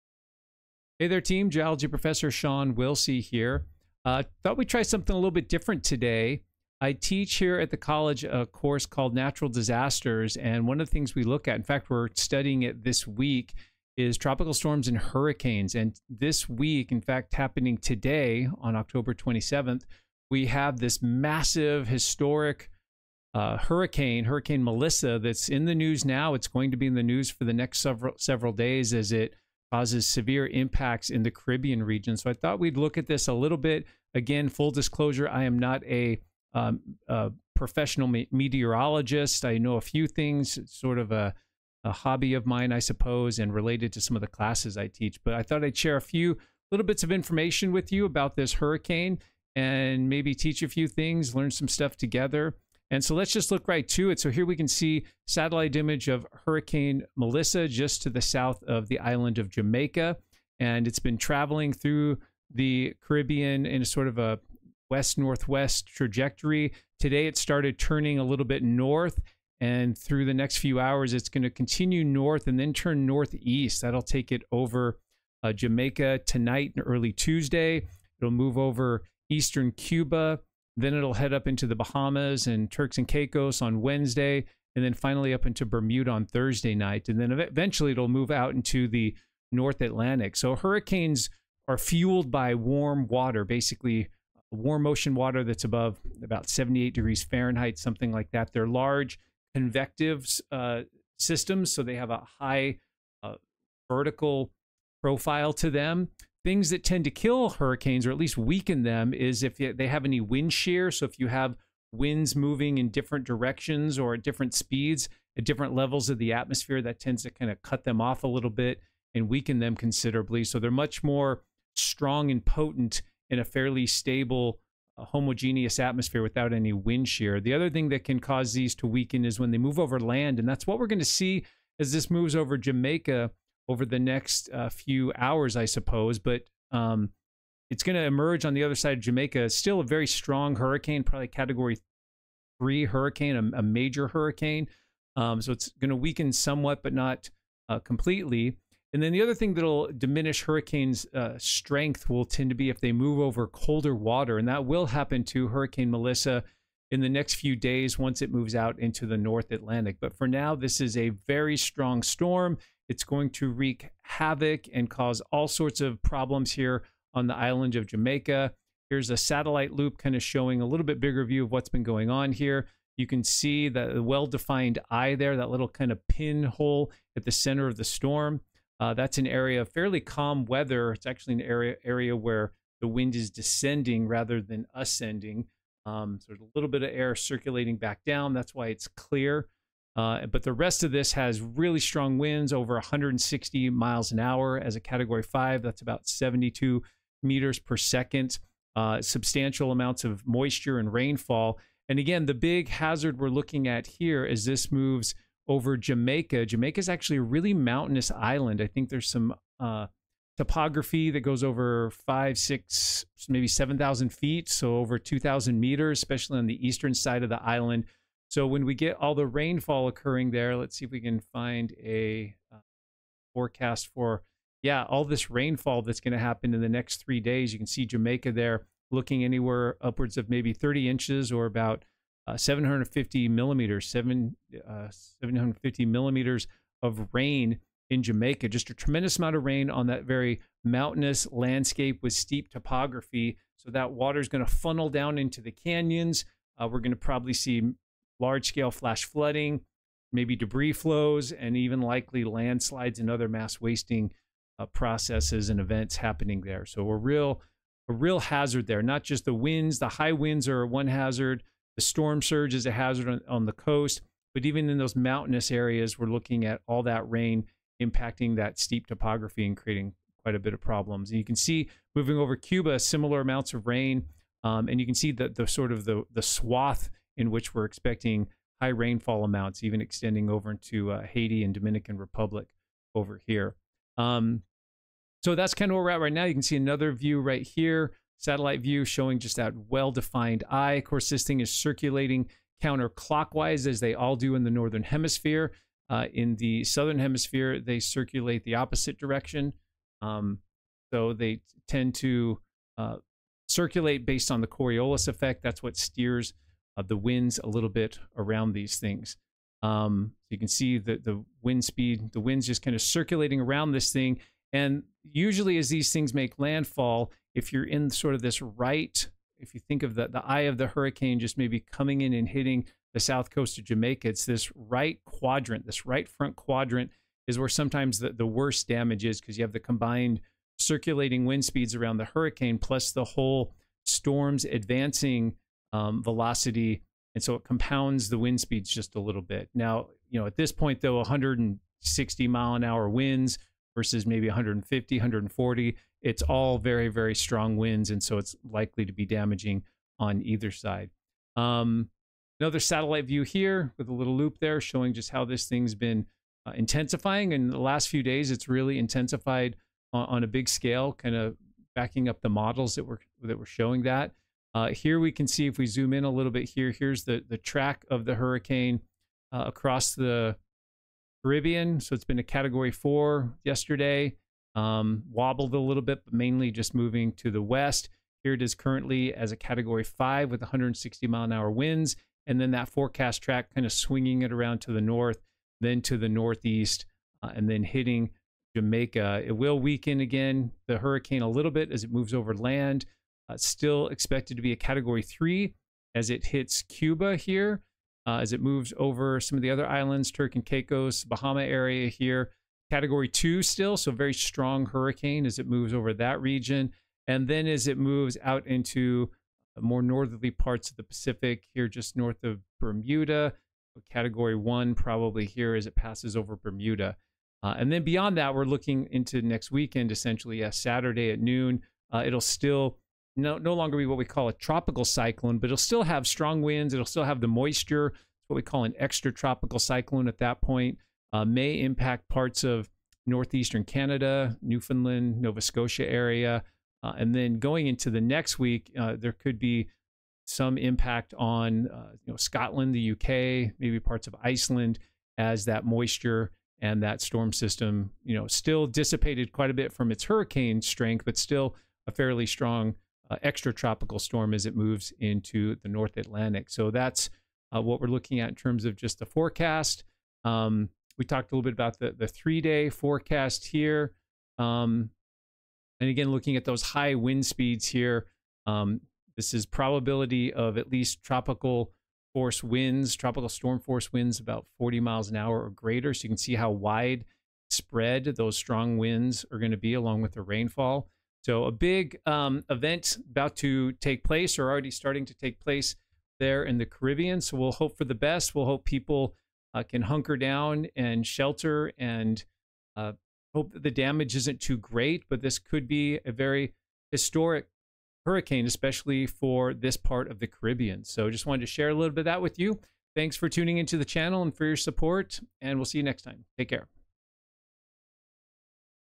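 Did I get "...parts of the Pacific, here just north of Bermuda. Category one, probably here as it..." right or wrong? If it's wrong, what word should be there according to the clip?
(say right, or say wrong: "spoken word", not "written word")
right.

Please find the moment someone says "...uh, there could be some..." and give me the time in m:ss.
7:18.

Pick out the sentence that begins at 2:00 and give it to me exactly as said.
So they're much more strong and potent in a fairly stable, uh, homogeneous atmosphere without any wind shear.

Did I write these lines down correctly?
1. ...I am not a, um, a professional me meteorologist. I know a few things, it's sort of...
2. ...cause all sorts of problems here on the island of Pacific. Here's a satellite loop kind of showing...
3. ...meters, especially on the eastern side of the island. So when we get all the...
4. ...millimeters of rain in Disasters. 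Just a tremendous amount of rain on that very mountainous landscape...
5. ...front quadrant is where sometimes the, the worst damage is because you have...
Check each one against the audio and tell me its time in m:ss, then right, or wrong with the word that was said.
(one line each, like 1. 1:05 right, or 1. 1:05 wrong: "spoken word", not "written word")
1. 0:35 right
2. 2:44 wrong: "Jamaica", not "Pacific"
3. 3:35 right
4. 3:55 wrong: "Jamaica", not "Disasters"
5. 5:26 right.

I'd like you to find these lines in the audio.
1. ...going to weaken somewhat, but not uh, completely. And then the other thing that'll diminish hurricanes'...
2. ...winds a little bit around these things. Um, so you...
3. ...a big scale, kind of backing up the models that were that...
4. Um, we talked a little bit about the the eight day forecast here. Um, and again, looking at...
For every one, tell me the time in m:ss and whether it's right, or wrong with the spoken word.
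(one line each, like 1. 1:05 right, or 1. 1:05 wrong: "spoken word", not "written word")
1. 2:25 right
2. 5:06 right
3. 6:00 right
4. 7:40 wrong: "three", not "eight".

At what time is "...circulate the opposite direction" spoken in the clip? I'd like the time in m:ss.
4:57.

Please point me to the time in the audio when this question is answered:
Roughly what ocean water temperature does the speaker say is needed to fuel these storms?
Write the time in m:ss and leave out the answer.
1:36.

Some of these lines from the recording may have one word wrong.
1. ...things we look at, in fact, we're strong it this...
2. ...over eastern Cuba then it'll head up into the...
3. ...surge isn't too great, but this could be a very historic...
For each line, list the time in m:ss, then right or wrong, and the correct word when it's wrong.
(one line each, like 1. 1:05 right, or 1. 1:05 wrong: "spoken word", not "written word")
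1. 0:10 wrong: "studying", not "strong"
2. 1:18 right
3. 8:13 wrong: "damage", not "surge".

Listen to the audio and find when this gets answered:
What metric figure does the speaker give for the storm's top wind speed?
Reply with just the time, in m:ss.
3:16.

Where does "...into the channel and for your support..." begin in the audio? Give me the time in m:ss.
8:23.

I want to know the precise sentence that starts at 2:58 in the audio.
Uh, that's an area of fairly calm weather.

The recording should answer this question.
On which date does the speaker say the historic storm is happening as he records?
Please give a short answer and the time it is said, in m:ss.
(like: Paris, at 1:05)
October 27th, at 0:18.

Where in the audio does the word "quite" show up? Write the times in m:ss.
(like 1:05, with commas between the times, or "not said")
4:30, 7:29.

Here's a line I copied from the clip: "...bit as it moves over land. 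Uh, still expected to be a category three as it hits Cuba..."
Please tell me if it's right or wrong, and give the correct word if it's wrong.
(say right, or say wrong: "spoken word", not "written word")
right.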